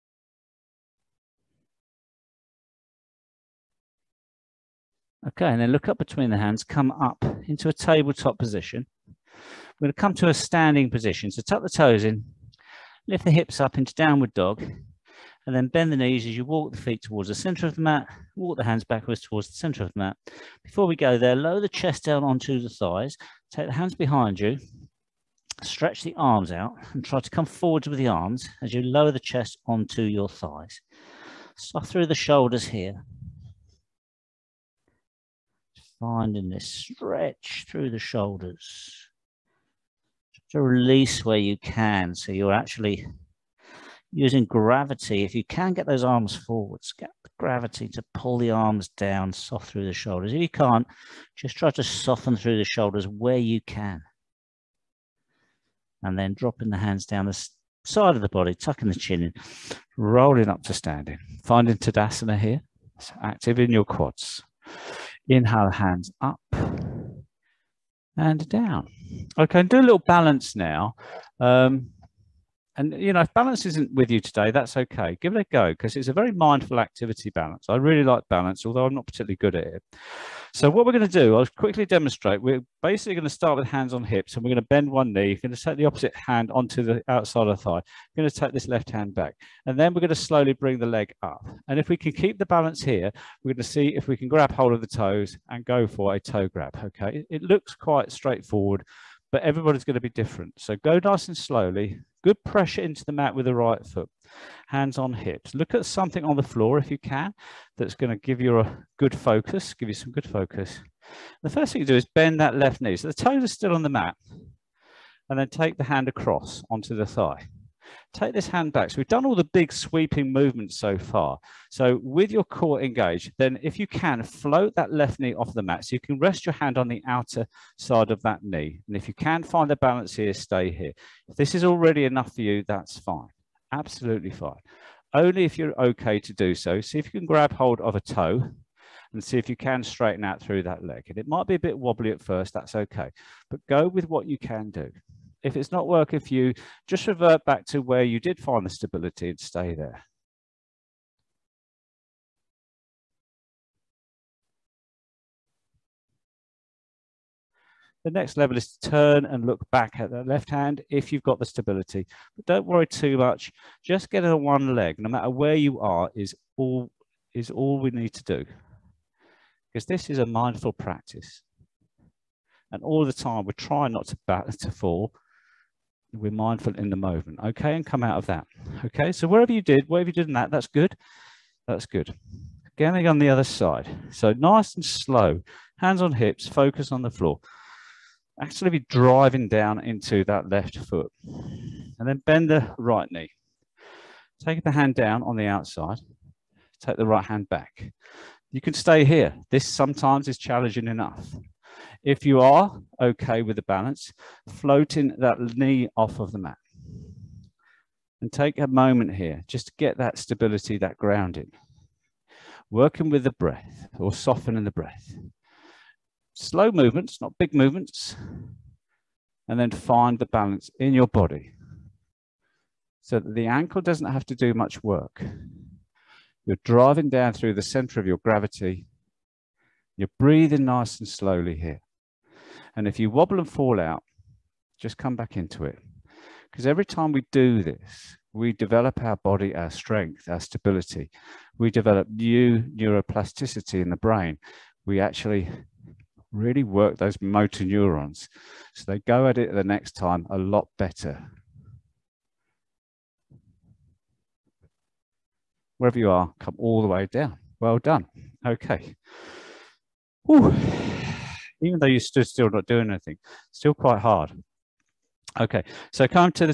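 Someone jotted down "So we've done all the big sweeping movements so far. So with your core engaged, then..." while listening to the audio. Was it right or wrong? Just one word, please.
right.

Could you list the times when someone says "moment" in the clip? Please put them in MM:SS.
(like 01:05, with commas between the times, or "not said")
02:56, 03:28.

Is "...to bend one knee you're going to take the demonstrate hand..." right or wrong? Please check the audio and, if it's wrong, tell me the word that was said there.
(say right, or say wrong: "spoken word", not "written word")
wrong: "opposite", not "demonstrate".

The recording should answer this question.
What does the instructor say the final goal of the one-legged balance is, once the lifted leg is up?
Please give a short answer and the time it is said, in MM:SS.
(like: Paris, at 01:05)
toe grab, at 01:36.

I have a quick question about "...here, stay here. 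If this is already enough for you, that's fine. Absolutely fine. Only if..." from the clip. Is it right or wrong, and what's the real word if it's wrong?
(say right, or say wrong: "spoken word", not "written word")
right.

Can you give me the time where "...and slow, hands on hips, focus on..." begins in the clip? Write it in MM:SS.
03:04.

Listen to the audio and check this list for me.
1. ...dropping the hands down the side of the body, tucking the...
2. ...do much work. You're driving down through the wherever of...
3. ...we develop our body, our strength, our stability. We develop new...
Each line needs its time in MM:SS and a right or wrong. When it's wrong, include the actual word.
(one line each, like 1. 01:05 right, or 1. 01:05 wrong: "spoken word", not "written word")
1. 00:56 right
2. 03:44 wrong: "center", not "wherever"
3. 03:58 right.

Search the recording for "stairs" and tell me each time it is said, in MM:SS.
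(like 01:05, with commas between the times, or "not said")
not said.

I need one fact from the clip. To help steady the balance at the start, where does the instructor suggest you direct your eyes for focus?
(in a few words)
something on the floor.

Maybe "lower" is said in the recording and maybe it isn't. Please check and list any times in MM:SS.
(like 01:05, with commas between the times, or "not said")
00:21, 00:28.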